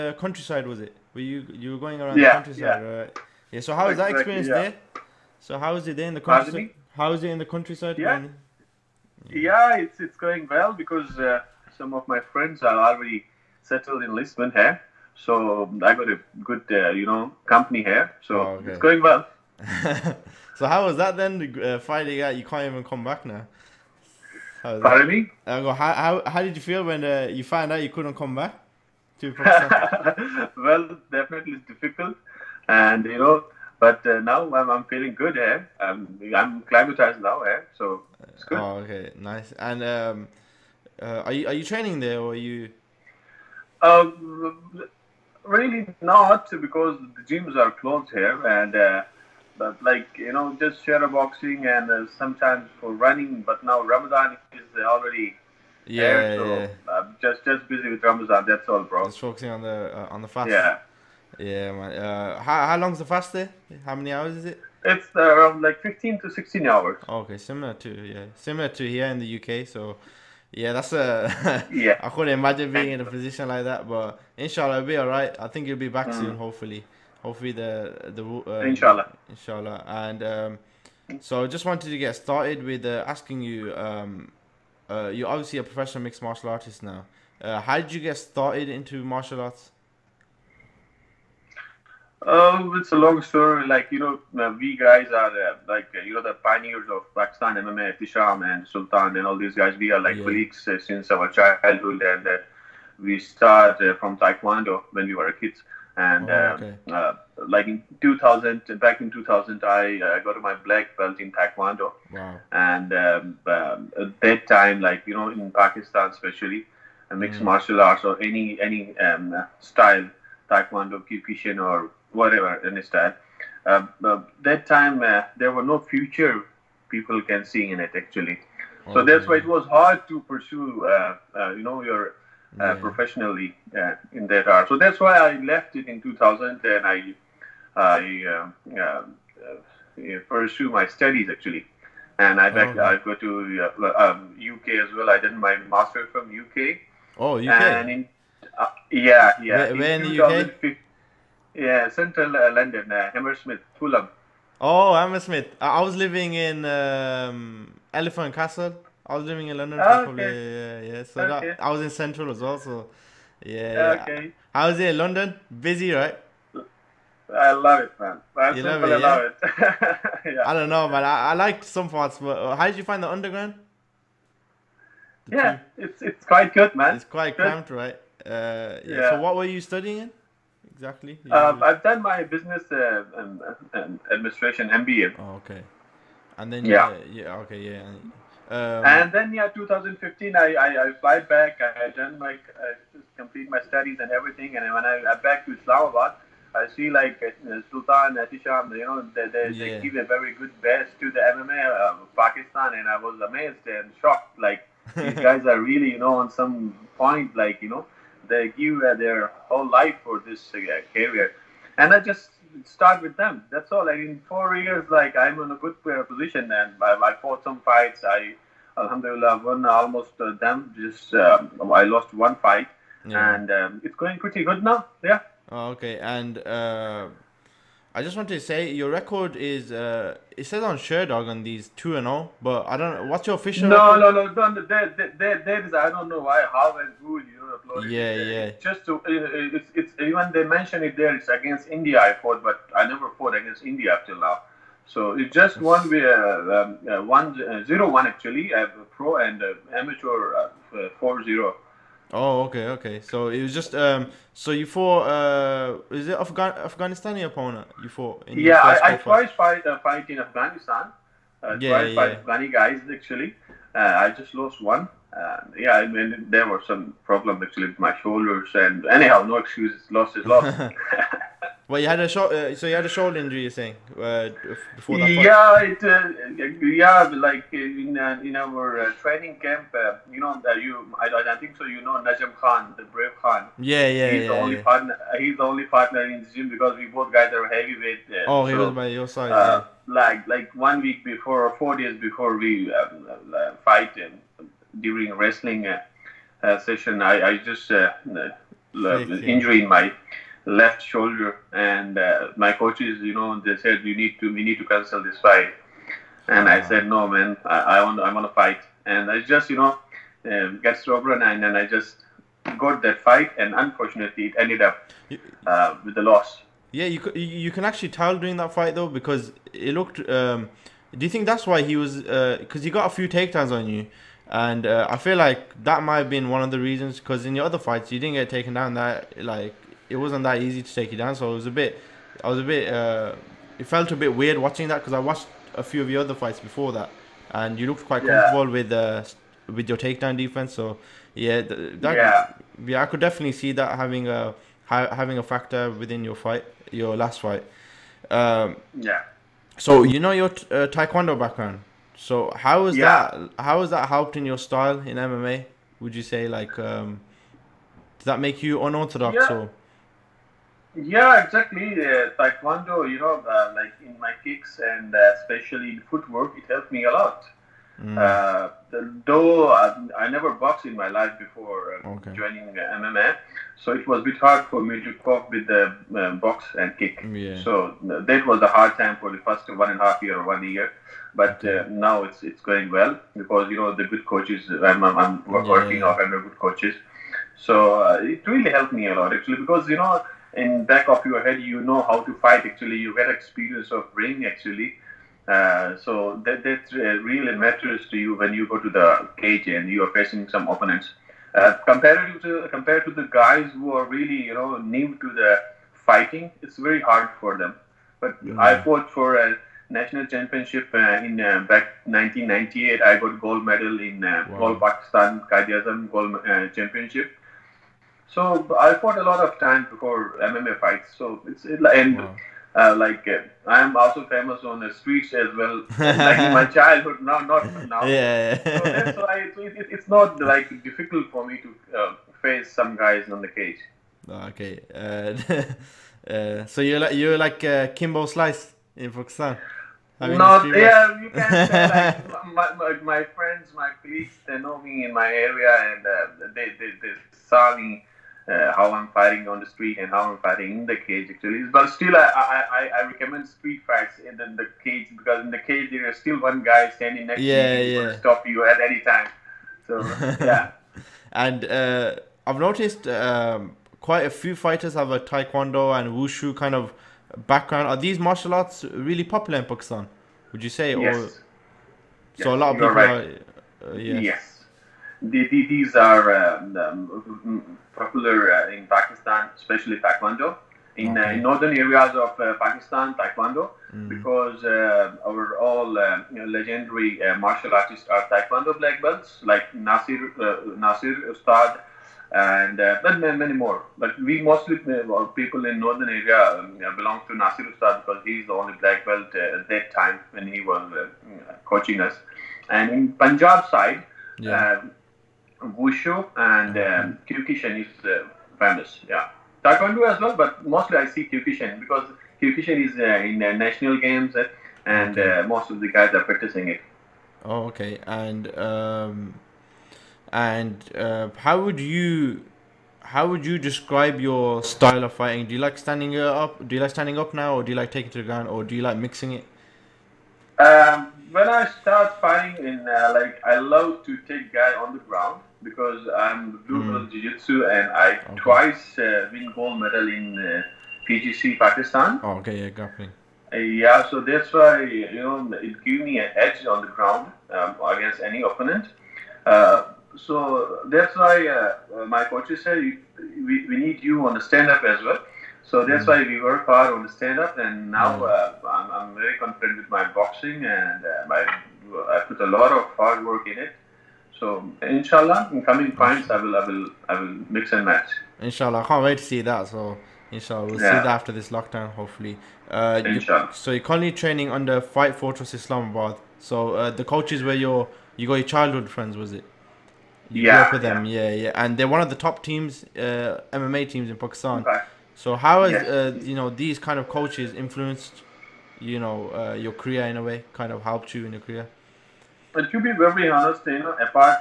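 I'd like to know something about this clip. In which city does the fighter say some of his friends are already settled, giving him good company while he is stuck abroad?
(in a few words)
Lisbon.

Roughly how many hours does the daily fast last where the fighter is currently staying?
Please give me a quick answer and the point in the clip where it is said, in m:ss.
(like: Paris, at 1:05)
15 to 16 hours, at 1:05.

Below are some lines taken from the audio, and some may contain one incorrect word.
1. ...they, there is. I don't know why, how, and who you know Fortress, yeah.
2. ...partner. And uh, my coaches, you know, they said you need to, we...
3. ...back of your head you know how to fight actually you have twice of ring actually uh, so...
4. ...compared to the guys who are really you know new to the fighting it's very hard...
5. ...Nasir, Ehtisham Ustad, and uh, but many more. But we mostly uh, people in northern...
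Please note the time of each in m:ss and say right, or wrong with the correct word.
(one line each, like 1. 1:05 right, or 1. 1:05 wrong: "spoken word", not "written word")
1. 3:55 wrong: "Yeah", not "Fortress"
2. 5:00 wrong: "shoulder", not "partner"
3. 6:30 wrong: "experience", not "twice"
4. 6:42 right
5. 8:09 wrong: "Nasir", not "Ehtisham".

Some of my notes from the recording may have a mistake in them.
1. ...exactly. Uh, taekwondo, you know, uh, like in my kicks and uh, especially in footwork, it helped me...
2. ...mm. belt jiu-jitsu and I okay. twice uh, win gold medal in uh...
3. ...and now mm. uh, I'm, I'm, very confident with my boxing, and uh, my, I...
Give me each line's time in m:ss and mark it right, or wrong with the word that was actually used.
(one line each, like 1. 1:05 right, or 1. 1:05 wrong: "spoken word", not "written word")
1. 6:01 right
2. 8:56 right
3. 9:17 right.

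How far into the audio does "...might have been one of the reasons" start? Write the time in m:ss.
5:25.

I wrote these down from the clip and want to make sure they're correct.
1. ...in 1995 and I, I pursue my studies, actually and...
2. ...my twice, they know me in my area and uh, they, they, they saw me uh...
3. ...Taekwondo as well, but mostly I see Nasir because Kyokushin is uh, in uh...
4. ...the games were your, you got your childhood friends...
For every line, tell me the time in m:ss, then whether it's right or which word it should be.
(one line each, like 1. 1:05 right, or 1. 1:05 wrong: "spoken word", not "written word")
1. 2:15 wrong: "2000", not "1995"
2. 7:23 wrong: "police", not "twice"
3. 8:29 wrong: "Kyokushin", not "Nasir"
4. 9:36 wrong: "coaches", not "games".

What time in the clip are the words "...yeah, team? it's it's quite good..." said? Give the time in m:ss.
2:55.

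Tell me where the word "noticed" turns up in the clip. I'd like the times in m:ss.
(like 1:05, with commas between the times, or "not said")
7:42.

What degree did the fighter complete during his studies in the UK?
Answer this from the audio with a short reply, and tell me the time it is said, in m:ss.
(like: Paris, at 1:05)
MBA, at 3:04.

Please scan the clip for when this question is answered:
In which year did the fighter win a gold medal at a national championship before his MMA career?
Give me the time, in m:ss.
6:51.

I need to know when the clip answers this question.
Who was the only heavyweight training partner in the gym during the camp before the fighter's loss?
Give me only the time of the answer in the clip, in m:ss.
4:41.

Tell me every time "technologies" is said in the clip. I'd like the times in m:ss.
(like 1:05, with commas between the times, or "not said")
not said.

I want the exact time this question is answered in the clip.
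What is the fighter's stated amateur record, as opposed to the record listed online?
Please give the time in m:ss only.
4:10.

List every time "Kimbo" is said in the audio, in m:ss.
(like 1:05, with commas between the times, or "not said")
7:17.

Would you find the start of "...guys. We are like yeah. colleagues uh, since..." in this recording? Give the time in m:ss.
1:39.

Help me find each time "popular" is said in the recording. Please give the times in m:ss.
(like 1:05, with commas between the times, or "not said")
7:49, 7:57.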